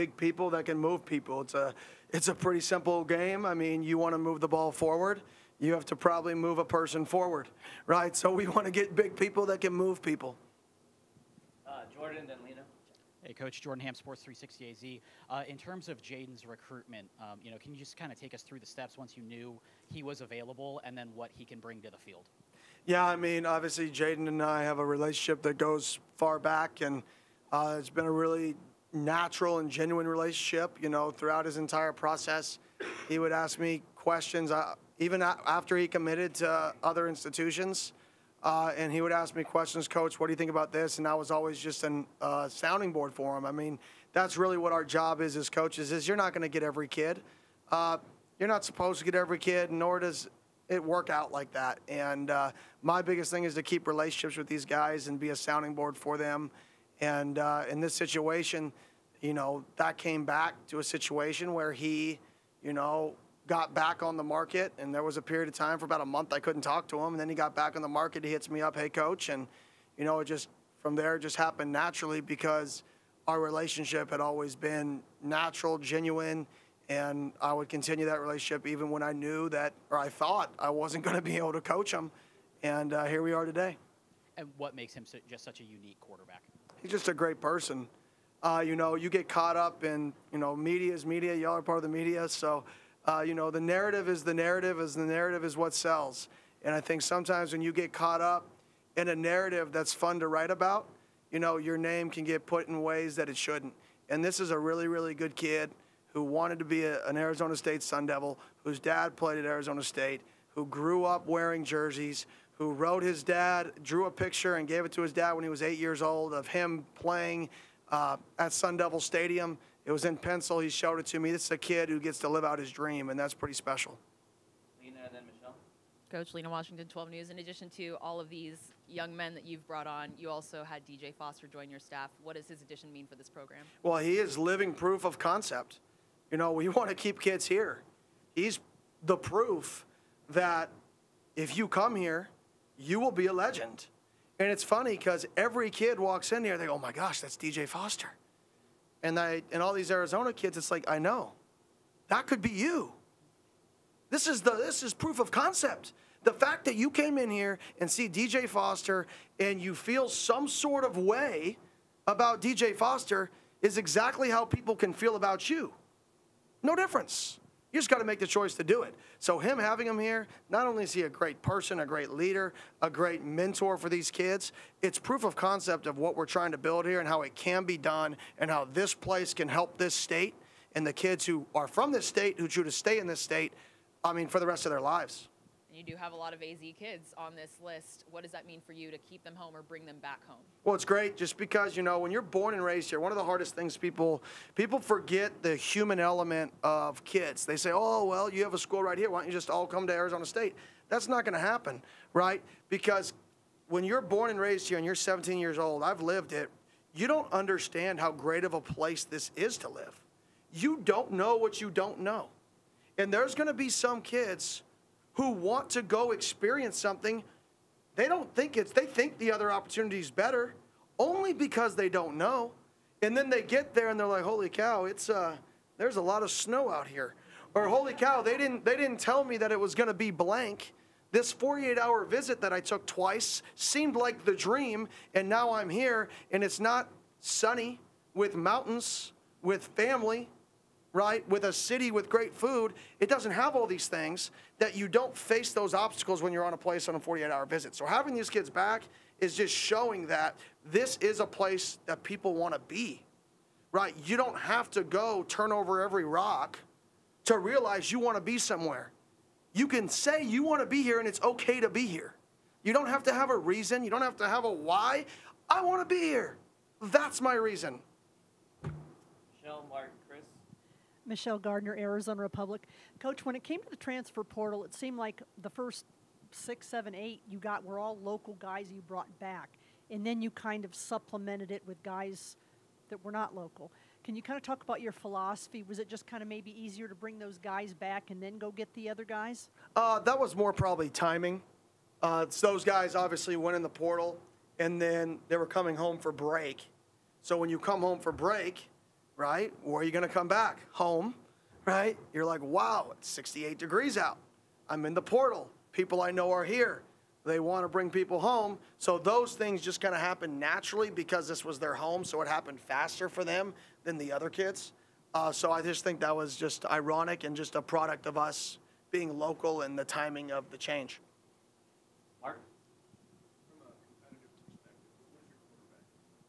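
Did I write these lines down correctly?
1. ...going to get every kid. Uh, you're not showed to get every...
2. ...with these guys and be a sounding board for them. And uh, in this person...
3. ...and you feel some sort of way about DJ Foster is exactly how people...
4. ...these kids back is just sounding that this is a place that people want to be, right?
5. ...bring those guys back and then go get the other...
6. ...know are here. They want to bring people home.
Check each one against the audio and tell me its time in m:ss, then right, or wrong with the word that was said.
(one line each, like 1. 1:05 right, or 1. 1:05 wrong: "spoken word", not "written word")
1. 0:46 wrong: "supposed", not "showed"
2. 0:54 wrong: "situation", not "person"
3. 2:39 right
4. 4:08 wrong: "showing", not "sounding"
5. 4:46 right
6. 5:06 right.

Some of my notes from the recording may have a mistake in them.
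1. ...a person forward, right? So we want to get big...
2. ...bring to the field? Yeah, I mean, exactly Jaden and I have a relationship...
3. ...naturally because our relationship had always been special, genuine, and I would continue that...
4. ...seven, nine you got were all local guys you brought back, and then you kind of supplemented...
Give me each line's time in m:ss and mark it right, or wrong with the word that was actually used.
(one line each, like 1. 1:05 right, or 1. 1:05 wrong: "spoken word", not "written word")
1. 0:06 right
2. 0:21 wrong: "obviously", not "exactly"
3. 1:11 wrong: "natural", not "special"
4. 4:36 wrong: "eight", not "nine".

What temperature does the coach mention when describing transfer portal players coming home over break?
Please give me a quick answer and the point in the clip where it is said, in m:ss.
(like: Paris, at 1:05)
68 degrees, at 5:03.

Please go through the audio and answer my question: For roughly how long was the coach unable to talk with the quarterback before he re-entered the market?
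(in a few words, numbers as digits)
About a month.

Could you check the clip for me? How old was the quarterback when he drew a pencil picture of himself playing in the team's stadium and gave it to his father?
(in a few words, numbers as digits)
8.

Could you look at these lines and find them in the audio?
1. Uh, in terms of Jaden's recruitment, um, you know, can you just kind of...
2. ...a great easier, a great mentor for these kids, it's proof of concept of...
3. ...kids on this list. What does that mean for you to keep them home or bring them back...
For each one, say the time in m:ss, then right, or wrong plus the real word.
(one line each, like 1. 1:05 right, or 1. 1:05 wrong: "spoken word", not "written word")
1. 0:15 right
2. 2:51 wrong: "leader", not "easier"
3. 3:06 right.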